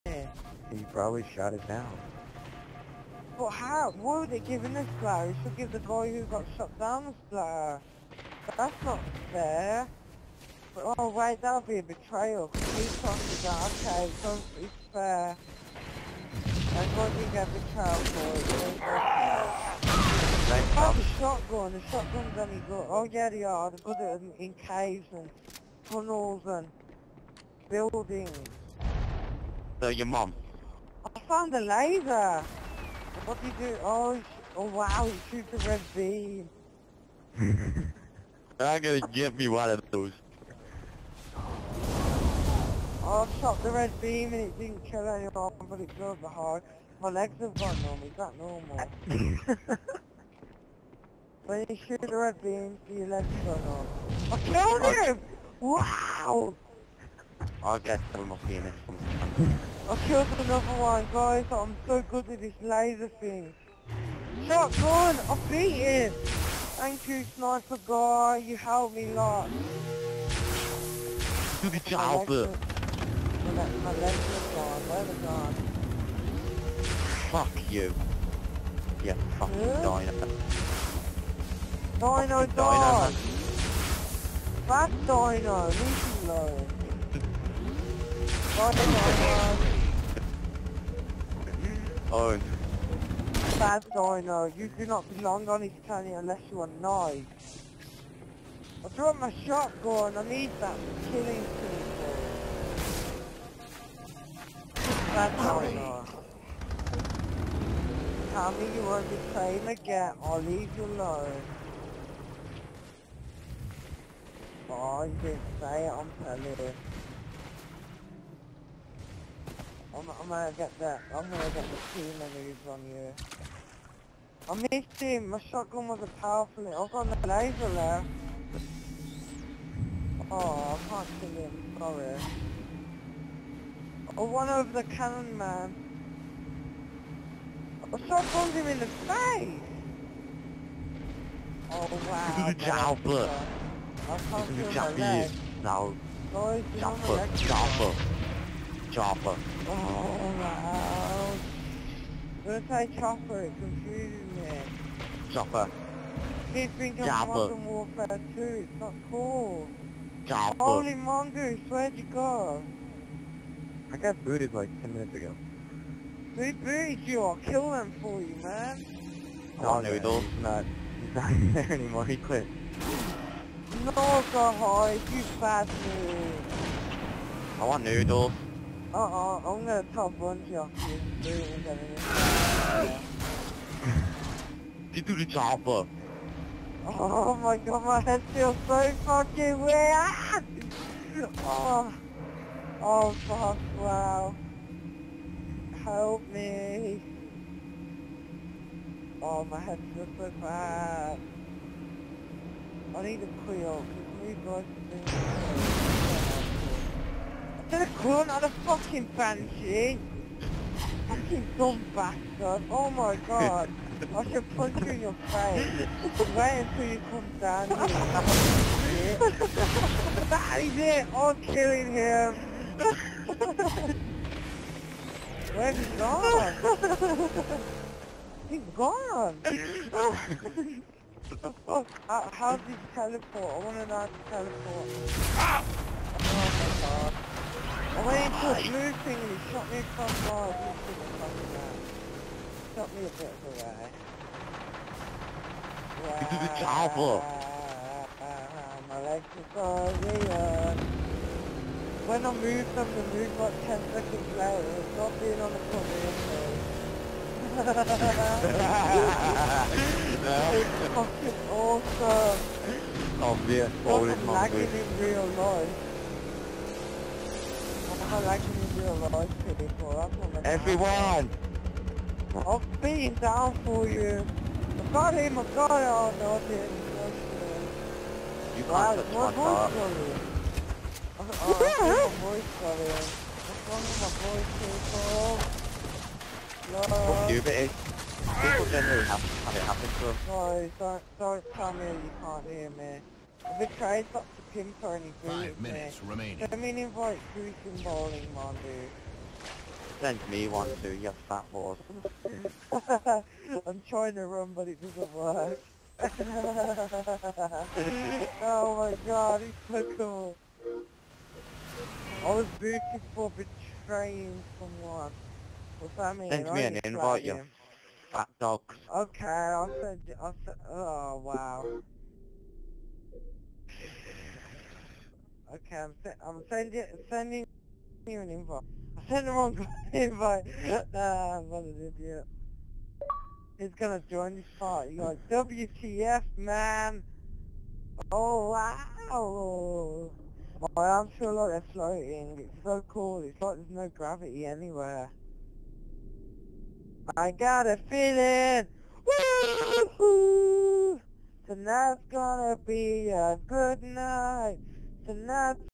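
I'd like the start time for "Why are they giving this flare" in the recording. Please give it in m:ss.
0:03.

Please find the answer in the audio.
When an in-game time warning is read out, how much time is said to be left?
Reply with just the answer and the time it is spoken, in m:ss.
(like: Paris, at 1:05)
5 minutes, at 4:55.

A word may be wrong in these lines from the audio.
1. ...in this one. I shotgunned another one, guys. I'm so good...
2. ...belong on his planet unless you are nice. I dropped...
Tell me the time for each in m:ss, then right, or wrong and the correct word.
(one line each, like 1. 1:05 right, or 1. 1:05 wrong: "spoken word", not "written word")
1. 0:58 wrong: "killed", not "shotgunned"
2. 1:35 right.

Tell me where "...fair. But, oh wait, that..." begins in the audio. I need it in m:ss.
0:09.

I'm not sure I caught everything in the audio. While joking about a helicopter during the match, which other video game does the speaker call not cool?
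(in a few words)
Modern Warfare 2.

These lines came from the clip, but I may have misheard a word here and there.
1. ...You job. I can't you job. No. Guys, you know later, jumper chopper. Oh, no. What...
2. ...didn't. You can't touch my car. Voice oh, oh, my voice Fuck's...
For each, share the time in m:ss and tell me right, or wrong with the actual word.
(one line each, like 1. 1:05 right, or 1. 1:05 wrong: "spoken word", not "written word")
1. 2:22 wrong: "jumper", not "later"
2. 4:36 wrong: "What", not "Fuck".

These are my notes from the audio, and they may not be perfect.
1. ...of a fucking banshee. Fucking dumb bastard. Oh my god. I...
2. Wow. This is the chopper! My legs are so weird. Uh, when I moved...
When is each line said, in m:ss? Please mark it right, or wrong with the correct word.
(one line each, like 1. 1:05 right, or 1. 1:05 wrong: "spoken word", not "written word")
1. 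3:28 right
2. 4:06 right.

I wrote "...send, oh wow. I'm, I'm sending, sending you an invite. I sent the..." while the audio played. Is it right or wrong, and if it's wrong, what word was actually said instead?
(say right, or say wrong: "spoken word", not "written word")
right.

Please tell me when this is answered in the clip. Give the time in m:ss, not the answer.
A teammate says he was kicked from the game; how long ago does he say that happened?
2:44.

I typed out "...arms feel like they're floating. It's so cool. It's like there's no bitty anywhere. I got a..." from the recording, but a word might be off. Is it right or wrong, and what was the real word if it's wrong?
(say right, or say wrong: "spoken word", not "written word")
wrong: "gravity", not "bitty".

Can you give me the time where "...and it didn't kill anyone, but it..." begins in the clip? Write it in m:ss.
0:44.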